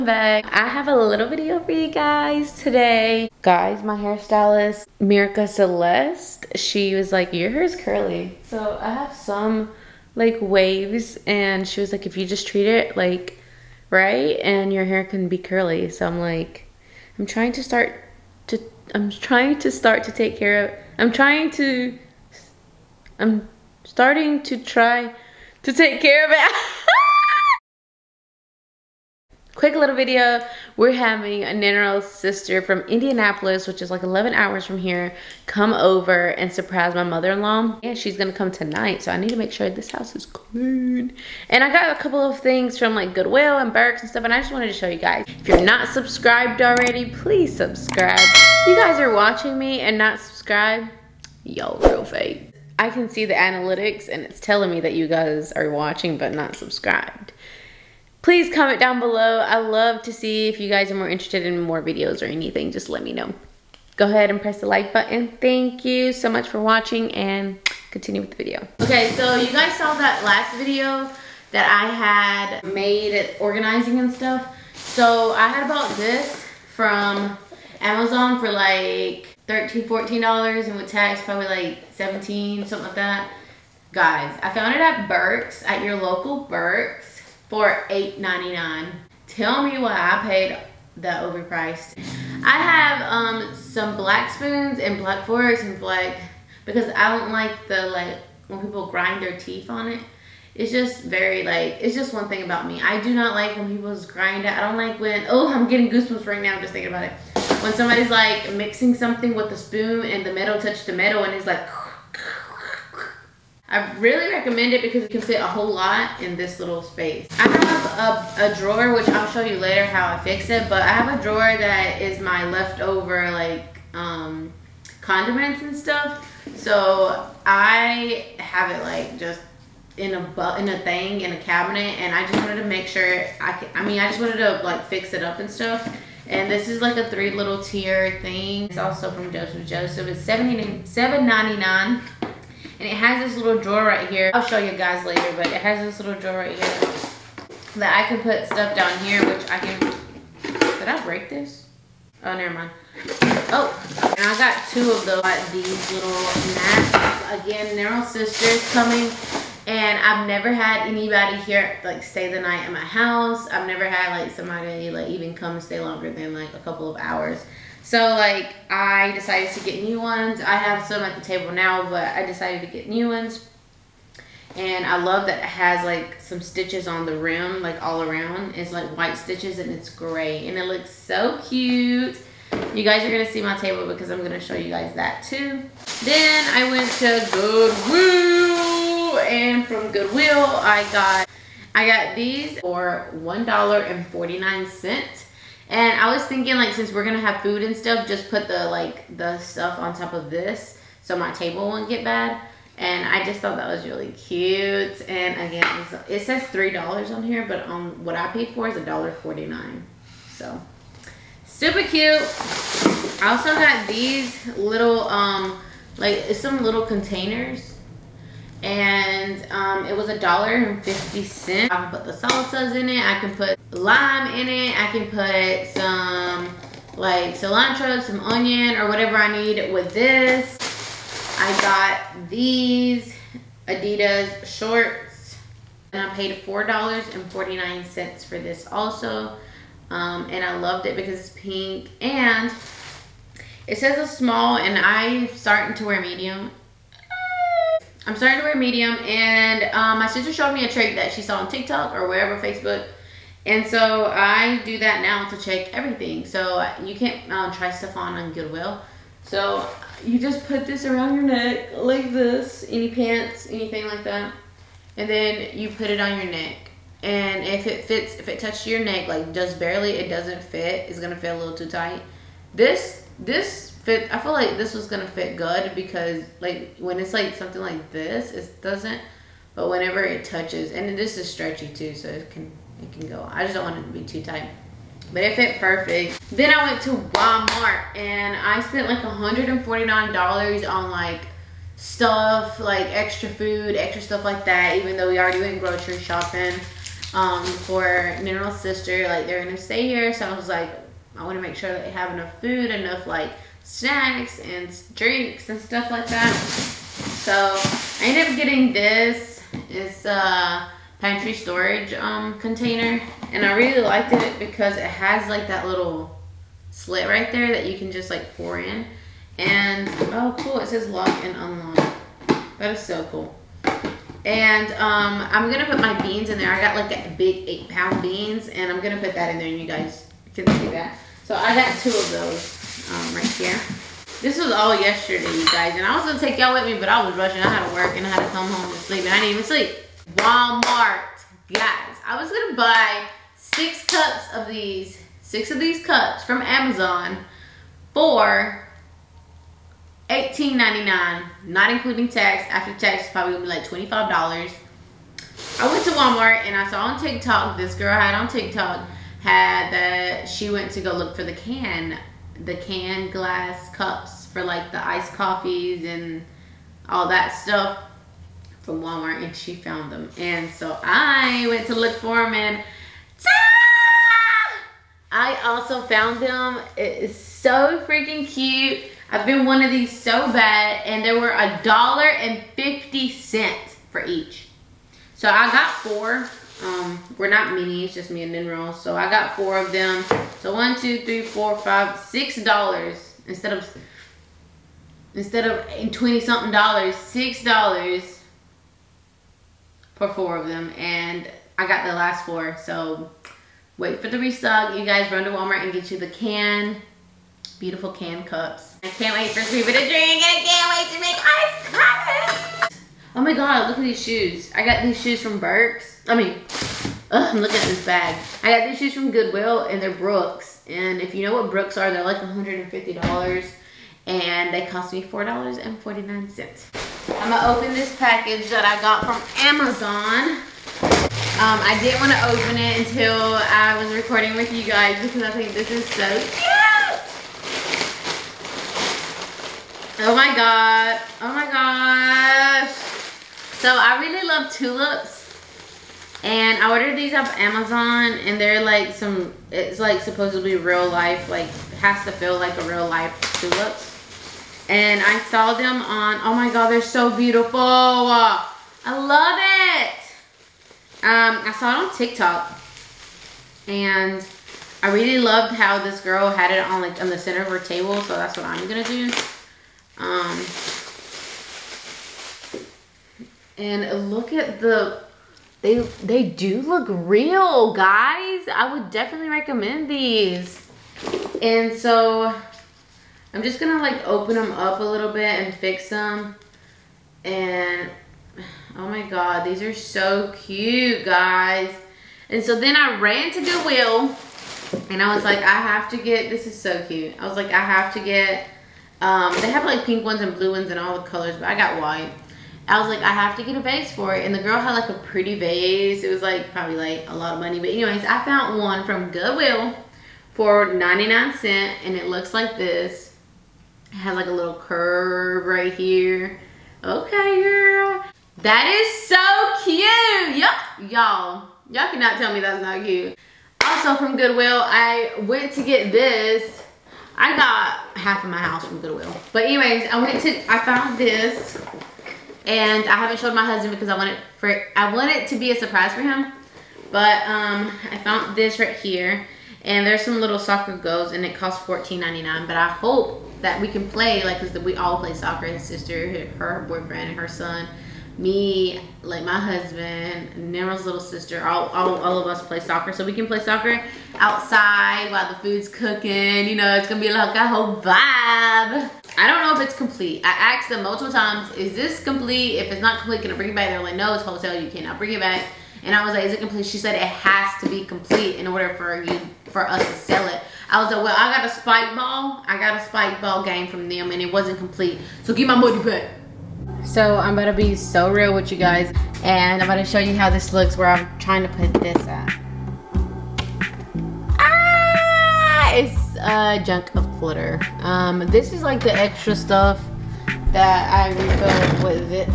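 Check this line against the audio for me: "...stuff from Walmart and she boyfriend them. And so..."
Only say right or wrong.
wrong.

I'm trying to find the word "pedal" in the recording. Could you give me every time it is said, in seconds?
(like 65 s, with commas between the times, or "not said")
not said.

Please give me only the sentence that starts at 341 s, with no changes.
Guys, I was going to buy six cups of these.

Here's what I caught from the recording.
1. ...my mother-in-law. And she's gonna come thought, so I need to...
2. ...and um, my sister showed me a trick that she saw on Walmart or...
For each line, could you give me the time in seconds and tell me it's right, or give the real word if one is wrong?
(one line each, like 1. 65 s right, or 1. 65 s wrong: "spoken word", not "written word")
1. 36 s wrong: "tonight", not "thought"
2. 249 s wrong: "TikTok", not "Walmart".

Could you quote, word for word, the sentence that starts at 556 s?
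You know, it's gonna be like a whole vibe.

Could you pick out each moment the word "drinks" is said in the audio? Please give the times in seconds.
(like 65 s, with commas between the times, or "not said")
304 s, 409 s.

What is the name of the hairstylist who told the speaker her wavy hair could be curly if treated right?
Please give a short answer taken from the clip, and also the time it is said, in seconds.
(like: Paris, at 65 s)
Mirka Celeste, at 5 s.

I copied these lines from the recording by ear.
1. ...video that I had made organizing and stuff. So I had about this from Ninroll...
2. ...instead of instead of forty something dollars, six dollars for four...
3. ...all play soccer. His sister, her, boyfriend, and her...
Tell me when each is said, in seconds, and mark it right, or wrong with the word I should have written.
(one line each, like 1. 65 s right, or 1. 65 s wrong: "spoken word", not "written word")
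1. 70 s wrong: "Amazon", not "Ninroll"
2. 393 s wrong: "twenty", not "forty"
3. 544 s right.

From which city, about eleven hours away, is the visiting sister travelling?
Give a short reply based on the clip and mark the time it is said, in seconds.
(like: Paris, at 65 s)
Indianapolis, at 32 s.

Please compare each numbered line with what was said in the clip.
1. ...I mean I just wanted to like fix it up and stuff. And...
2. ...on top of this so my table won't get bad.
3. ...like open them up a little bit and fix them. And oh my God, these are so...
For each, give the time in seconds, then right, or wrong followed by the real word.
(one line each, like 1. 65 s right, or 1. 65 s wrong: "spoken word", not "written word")
1. 133 s right
2. 199 s right
3. 483 s right.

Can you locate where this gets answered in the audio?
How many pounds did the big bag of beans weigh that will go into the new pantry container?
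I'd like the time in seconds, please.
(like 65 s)
327 s.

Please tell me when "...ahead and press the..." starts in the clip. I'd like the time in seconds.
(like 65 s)
64 s.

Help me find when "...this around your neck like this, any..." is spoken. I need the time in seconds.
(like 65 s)
260 s.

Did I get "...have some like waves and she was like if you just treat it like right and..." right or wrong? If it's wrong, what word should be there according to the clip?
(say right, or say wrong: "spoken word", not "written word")
right.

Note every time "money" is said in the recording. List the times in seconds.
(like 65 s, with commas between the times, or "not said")
507 s, 575 s.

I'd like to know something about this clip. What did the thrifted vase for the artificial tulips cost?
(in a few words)
99 cents.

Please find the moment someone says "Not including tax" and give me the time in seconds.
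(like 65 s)
351 s.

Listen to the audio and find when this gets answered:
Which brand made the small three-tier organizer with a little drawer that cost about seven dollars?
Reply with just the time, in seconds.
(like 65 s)
139 s.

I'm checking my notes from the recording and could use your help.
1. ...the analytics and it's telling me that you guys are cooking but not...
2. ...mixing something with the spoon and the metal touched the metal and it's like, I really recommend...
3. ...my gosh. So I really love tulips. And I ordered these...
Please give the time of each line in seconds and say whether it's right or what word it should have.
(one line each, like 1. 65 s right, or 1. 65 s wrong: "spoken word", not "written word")
1. 53 s wrong: "watching", not "cooking"
2. 108 s right
3. 441 s right.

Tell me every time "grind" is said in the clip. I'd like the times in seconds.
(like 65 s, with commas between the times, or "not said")
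98 s, 104 s.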